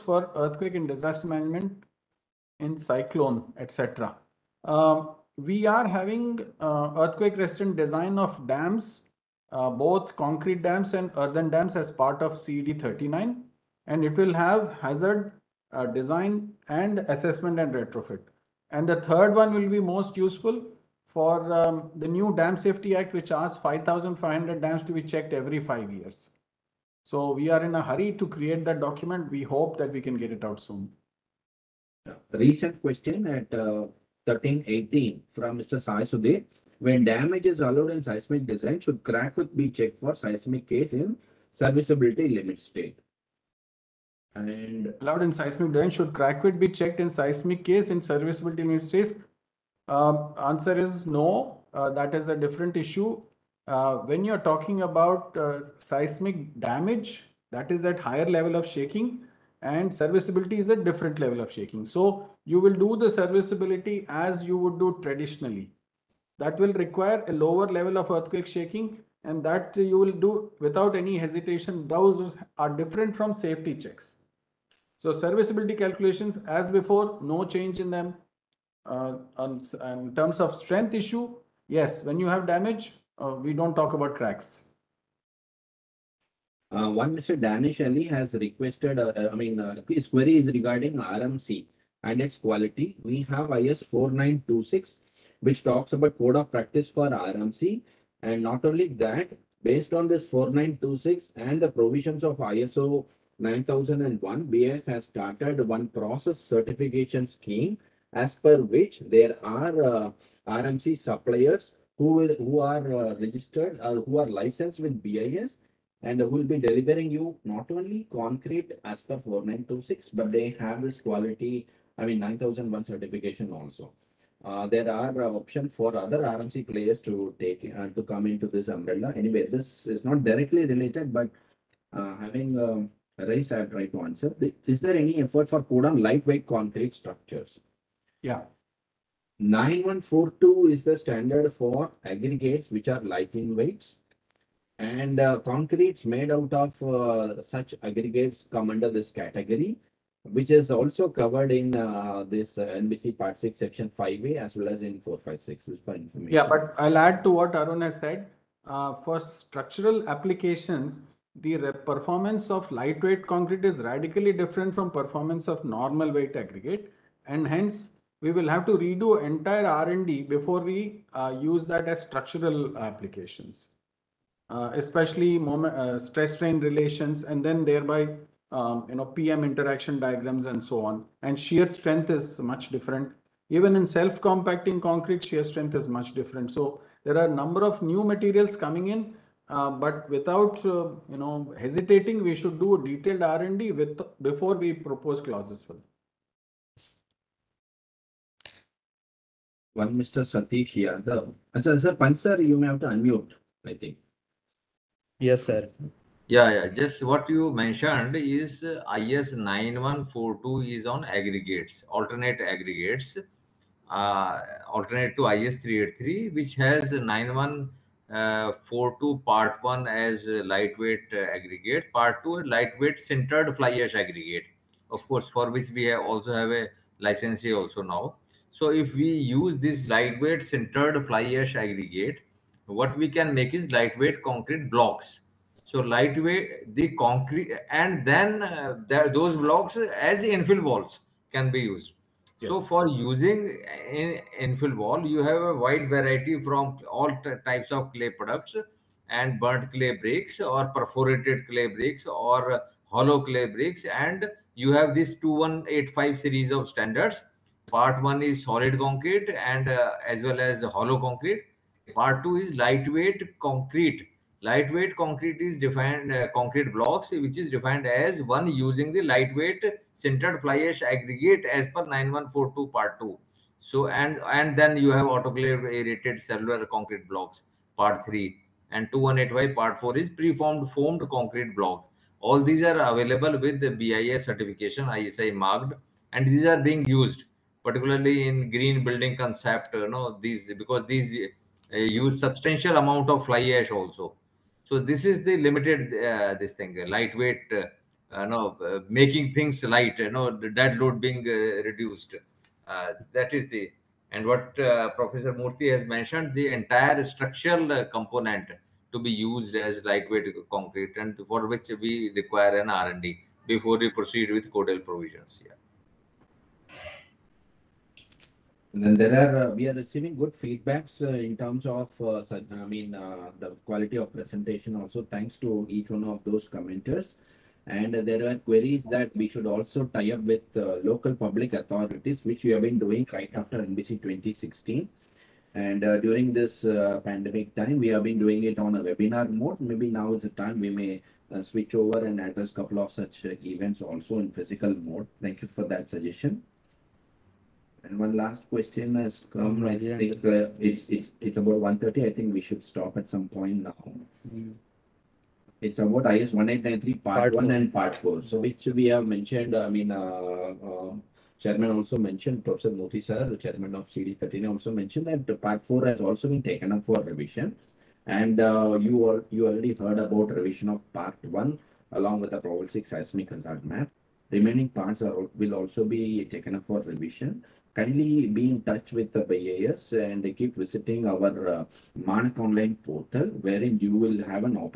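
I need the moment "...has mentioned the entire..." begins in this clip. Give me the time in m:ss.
5:05.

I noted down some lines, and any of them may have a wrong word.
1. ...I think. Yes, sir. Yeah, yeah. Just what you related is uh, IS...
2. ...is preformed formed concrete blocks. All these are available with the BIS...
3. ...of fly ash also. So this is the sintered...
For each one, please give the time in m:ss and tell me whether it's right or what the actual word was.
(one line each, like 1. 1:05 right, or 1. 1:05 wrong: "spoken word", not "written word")
1. 3:23 wrong: "mentioned", not "related"
2. 4:39 right
3. 4:53 wrong: "limited", not "sintered".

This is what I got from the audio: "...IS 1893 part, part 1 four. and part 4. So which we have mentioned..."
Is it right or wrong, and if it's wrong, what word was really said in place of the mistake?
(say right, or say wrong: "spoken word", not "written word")
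right.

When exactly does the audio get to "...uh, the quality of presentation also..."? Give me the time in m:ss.
5:22.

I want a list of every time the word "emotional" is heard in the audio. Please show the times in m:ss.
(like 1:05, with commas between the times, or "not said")
not said.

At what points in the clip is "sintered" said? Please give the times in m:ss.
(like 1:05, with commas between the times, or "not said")
3:42, 3:50, 4:29.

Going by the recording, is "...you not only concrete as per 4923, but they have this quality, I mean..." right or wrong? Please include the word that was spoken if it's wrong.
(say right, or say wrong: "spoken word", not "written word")
wrong: "4926", not "4923".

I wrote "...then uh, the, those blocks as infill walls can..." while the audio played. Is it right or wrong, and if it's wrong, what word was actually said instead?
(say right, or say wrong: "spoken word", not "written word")
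right.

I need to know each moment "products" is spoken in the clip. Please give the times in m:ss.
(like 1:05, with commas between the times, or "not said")
4:08.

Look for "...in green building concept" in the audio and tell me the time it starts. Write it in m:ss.
4:48.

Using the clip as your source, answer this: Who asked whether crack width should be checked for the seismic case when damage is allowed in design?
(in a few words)
Sai Sudhir.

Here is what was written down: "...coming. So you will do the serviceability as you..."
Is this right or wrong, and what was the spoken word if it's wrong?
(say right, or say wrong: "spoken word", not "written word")
wrong: "shaking", not "coming".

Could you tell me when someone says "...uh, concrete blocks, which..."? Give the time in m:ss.
4:26.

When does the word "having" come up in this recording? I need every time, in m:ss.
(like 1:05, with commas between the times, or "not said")
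0:05, 2:12.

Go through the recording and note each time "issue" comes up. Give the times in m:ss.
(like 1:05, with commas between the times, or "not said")
0:52, 1:20.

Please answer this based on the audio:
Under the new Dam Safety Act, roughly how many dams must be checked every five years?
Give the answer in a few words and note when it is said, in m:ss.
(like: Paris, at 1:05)
5,500, at 0:23.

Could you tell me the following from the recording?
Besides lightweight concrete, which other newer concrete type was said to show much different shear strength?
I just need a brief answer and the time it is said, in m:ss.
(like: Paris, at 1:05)
Self-compacting concrete, at 3:03.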